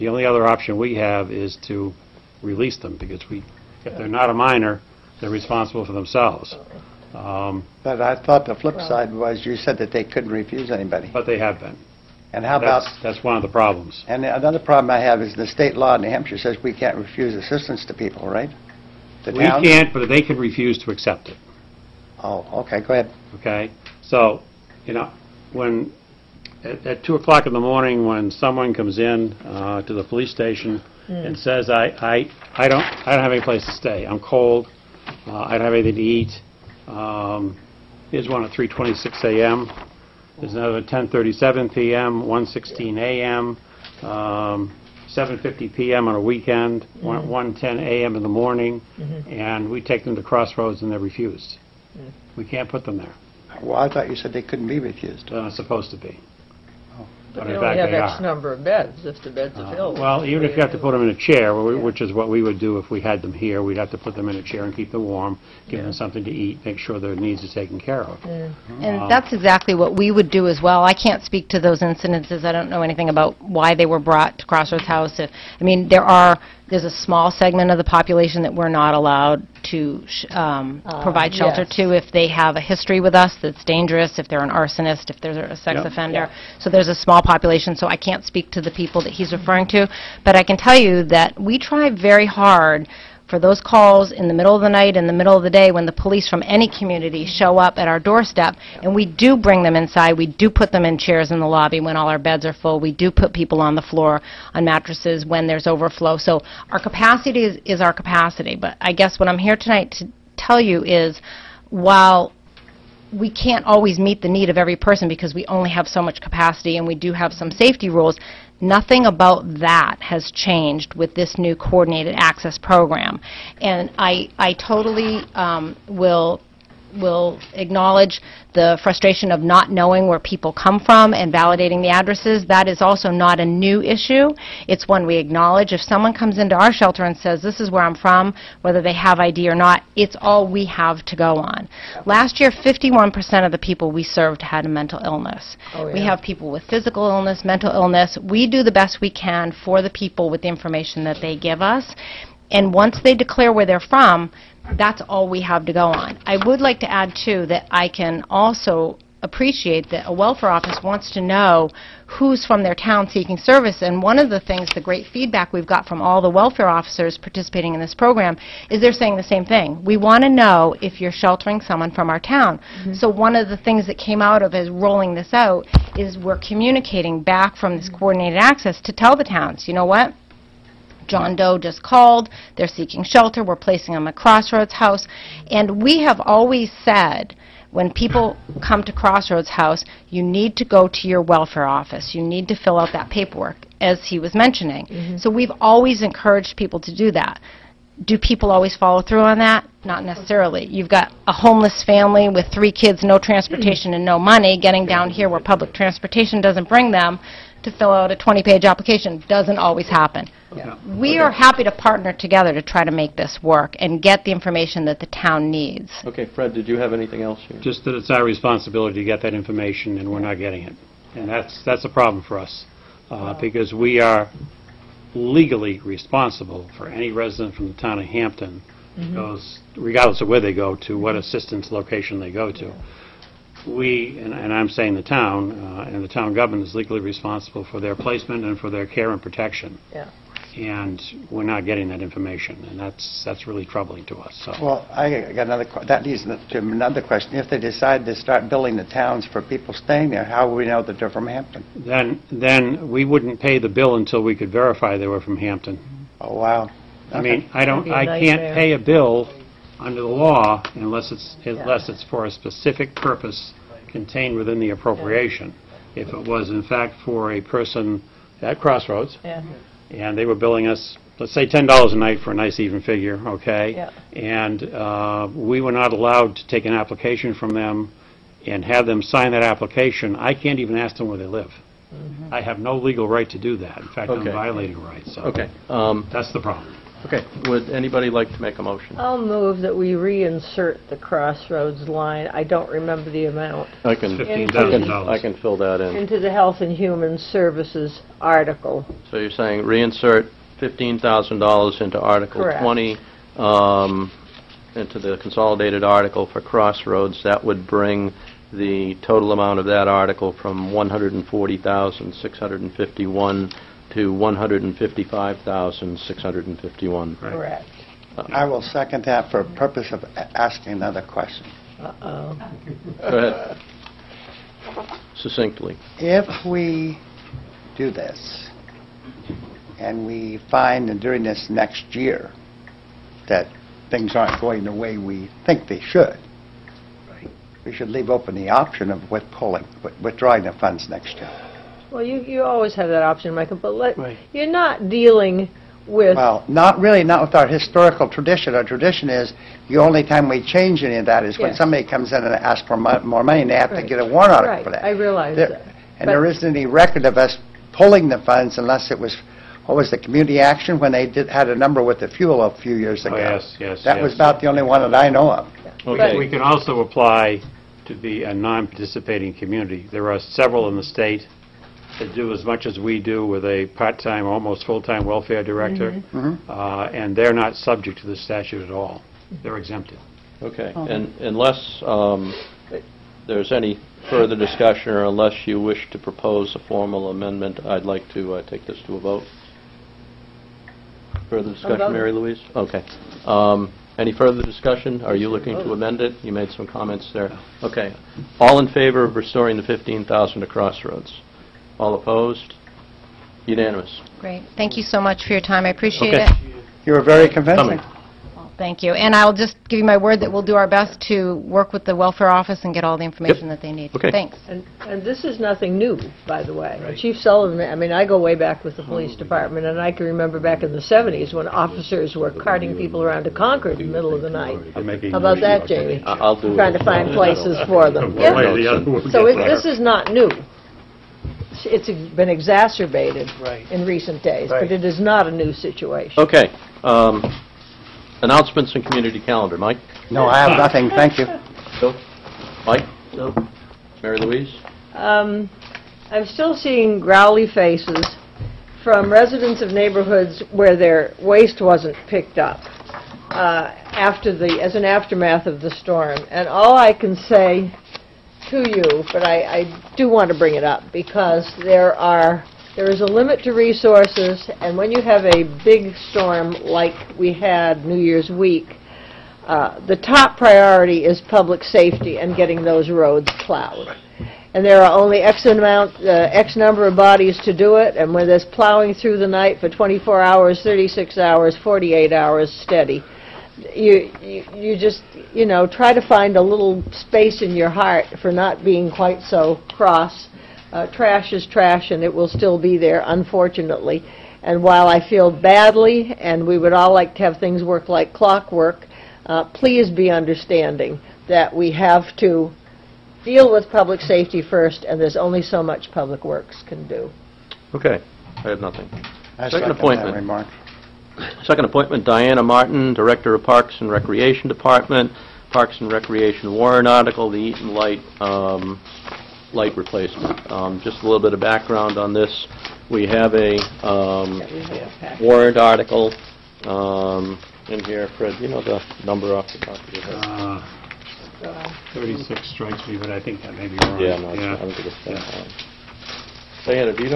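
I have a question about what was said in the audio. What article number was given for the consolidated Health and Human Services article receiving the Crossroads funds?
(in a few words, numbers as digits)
20.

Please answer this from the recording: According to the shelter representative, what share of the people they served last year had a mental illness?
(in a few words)
51%.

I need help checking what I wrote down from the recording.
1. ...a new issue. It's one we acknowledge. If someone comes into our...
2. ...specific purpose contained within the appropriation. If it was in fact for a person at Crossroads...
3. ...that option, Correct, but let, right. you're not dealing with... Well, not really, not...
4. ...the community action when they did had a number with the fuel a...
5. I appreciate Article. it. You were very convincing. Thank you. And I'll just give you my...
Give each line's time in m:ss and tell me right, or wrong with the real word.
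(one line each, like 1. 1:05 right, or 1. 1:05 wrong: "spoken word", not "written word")
1. 2:13 right
2. 4:22 right
3. 5:42 wrong: "Michael", not "Correct"
4. 5:59 right
5. 6:45 wrong: "Okay", not "Article".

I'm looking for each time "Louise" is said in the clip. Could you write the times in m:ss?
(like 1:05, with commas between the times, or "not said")
6:32, 7:24.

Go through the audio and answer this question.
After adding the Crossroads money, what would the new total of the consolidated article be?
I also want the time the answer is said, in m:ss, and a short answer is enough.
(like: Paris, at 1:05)
155,651, at 5:14.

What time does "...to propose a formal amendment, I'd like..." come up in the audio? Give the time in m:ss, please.
6:25.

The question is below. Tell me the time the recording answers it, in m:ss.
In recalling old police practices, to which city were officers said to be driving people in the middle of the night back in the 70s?
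7:03.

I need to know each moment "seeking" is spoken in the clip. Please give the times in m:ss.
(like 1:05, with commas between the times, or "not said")
2:43, 3:02.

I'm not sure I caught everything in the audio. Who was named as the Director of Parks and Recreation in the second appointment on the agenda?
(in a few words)
Diana Martin.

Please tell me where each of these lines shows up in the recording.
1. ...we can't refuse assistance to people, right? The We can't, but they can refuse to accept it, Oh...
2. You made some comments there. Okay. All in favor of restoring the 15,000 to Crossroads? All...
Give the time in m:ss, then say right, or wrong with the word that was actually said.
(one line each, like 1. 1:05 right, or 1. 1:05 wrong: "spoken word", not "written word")
1. 0:16 right
2. 6:36 right.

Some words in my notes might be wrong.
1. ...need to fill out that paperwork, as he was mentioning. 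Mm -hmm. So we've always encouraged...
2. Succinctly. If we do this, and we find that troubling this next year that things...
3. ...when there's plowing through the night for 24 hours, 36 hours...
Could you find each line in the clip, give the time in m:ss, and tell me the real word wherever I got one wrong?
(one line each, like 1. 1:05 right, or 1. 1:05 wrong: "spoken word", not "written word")
1. 3:12 right
2. 5:25 wrong: "during", not "troubling"
3. 7:58 right.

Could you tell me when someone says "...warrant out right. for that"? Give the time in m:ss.
5:54.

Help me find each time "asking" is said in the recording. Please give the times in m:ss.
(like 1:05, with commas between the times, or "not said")
5:20.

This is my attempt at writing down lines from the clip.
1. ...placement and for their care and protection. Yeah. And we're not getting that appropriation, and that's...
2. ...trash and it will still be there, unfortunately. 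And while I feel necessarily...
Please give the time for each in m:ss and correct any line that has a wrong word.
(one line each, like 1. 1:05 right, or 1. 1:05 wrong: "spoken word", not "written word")
1. 3:57 wrong: "information", not "appropriation"
2. 8:11 wrong: "badly", not "necessarily".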